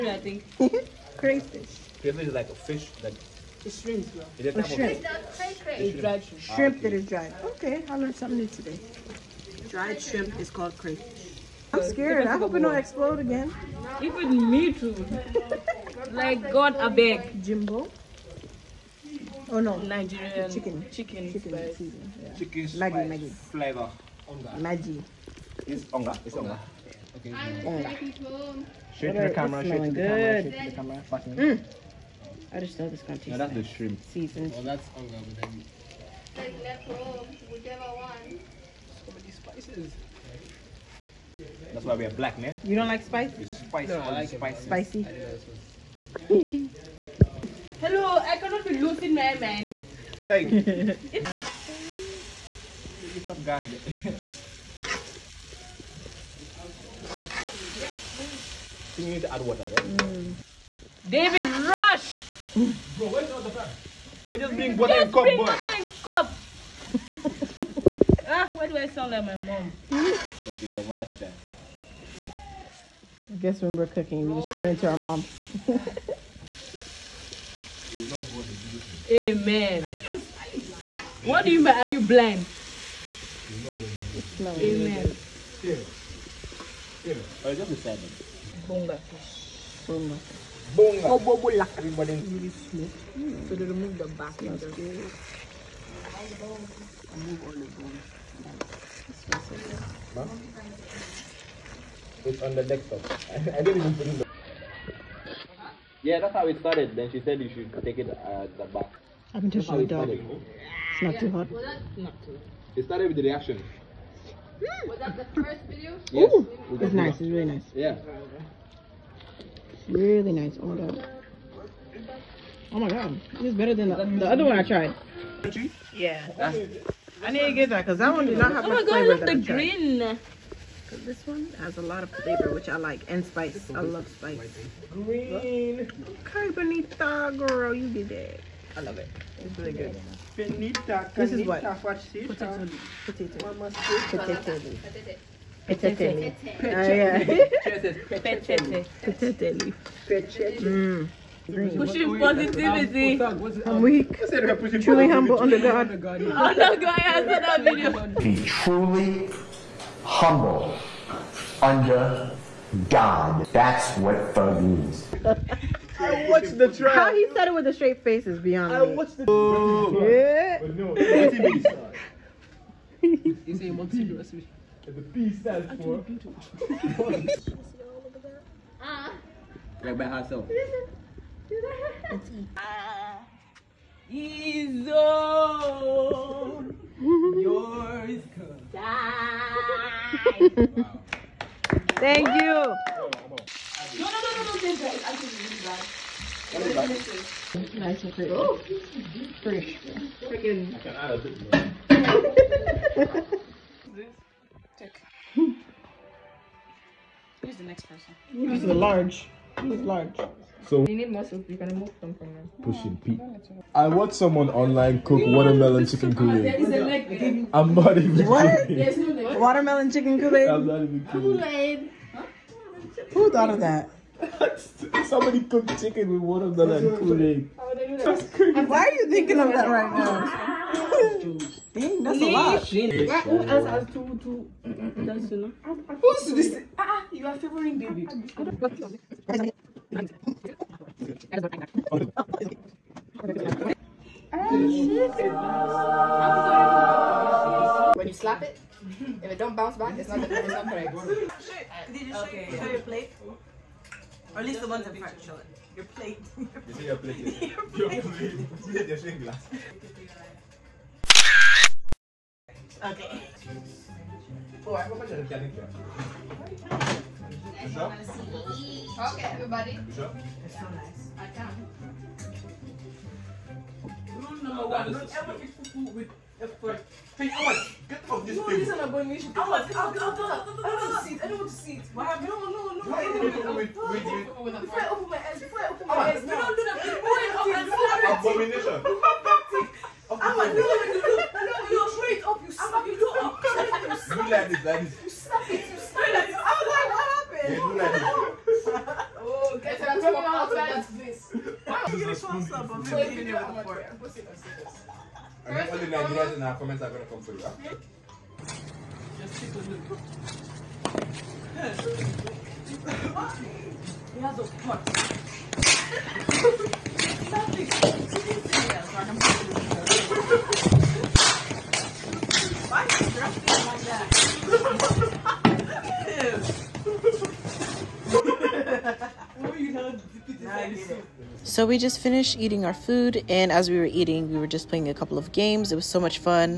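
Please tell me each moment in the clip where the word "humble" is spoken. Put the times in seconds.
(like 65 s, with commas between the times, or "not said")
155 s, 160 s.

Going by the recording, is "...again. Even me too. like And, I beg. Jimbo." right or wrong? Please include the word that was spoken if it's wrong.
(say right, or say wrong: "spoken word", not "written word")
wrong: "God", not "And".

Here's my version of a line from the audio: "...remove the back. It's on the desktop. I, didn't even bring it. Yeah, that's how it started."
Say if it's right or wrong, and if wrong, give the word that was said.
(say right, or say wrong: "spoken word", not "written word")
right.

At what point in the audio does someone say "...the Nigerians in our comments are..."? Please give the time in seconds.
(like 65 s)
305 s.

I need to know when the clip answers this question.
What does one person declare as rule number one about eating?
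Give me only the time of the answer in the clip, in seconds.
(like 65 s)
274 s.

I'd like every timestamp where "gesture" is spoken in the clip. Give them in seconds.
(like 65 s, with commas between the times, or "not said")
not said.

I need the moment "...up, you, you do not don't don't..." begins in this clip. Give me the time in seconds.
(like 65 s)
292 s.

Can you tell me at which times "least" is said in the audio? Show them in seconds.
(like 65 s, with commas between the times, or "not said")
254 s.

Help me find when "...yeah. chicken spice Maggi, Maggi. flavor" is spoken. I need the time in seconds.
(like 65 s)
22 s.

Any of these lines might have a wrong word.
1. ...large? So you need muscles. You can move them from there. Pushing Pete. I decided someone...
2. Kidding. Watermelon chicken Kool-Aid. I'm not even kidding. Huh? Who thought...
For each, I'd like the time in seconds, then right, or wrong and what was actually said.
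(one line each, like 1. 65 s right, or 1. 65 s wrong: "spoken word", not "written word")
1. 209 s wrong: "watched", not "decided"
2. 218 s right.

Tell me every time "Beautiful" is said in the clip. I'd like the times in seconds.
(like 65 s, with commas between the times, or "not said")
175 s.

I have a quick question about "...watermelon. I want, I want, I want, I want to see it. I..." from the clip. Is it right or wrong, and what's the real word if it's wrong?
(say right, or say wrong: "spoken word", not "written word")
wrong: "abomination", not "watermelon".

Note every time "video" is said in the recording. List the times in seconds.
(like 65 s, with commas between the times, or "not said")
115 s, 157 s.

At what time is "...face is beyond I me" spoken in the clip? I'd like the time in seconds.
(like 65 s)
168 s.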